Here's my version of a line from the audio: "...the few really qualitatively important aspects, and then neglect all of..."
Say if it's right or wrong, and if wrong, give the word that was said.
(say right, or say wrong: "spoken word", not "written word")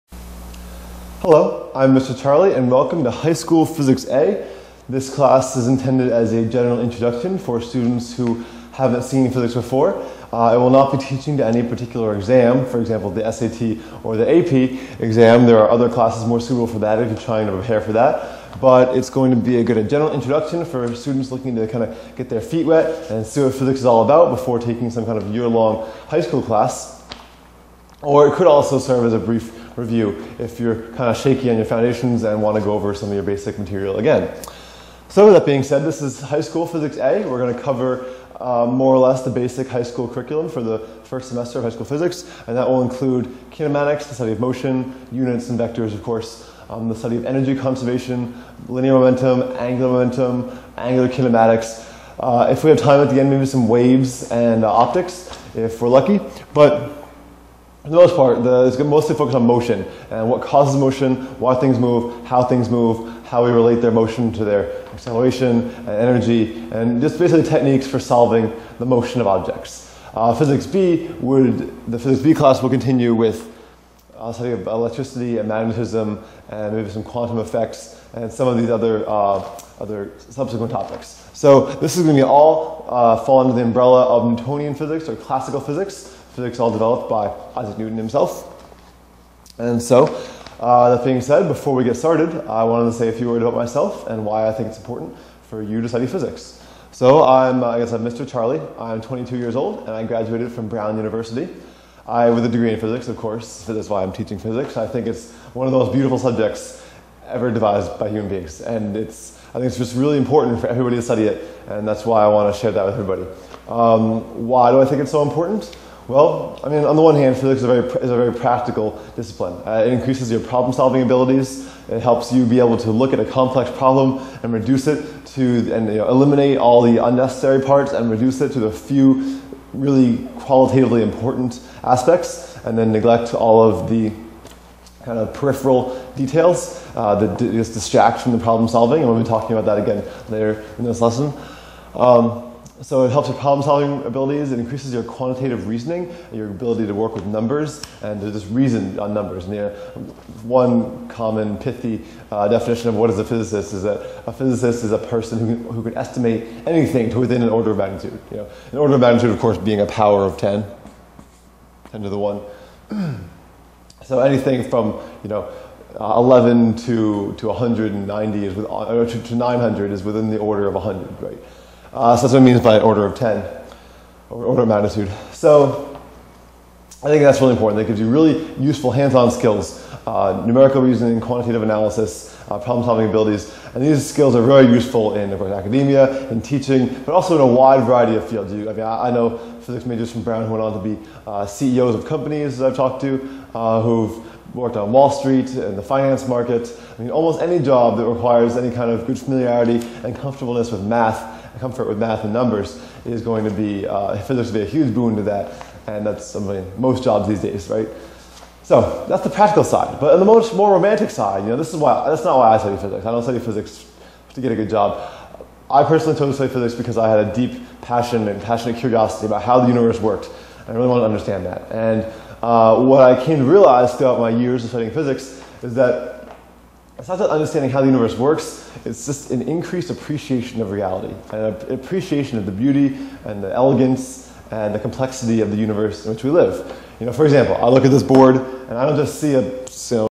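right.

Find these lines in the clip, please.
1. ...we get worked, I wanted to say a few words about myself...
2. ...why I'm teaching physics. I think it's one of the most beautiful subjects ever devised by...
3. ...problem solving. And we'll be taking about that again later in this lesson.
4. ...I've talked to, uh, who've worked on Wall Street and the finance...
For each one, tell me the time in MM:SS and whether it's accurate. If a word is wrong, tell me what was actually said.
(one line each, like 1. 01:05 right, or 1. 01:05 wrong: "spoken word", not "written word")
1. 01:31 wrong: "started", not "worked"
2. 01:43 right
3. 02:18 wrong: "talking", not "taking"
4. 03:12 right.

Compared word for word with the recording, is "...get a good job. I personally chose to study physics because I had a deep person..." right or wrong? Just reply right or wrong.
wrong.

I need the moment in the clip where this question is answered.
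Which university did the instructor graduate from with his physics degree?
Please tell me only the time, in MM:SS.
01:40.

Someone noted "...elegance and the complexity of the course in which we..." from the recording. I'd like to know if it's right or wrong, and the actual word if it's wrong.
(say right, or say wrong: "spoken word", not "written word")
wrong: "universe", not "course".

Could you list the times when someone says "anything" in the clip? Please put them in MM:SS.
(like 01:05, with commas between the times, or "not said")
02:36, 02:44.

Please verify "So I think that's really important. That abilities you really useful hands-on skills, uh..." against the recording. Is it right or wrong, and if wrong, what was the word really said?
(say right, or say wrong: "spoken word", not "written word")
wrong: "gives", not "abilities".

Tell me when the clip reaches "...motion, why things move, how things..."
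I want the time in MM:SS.
01:00.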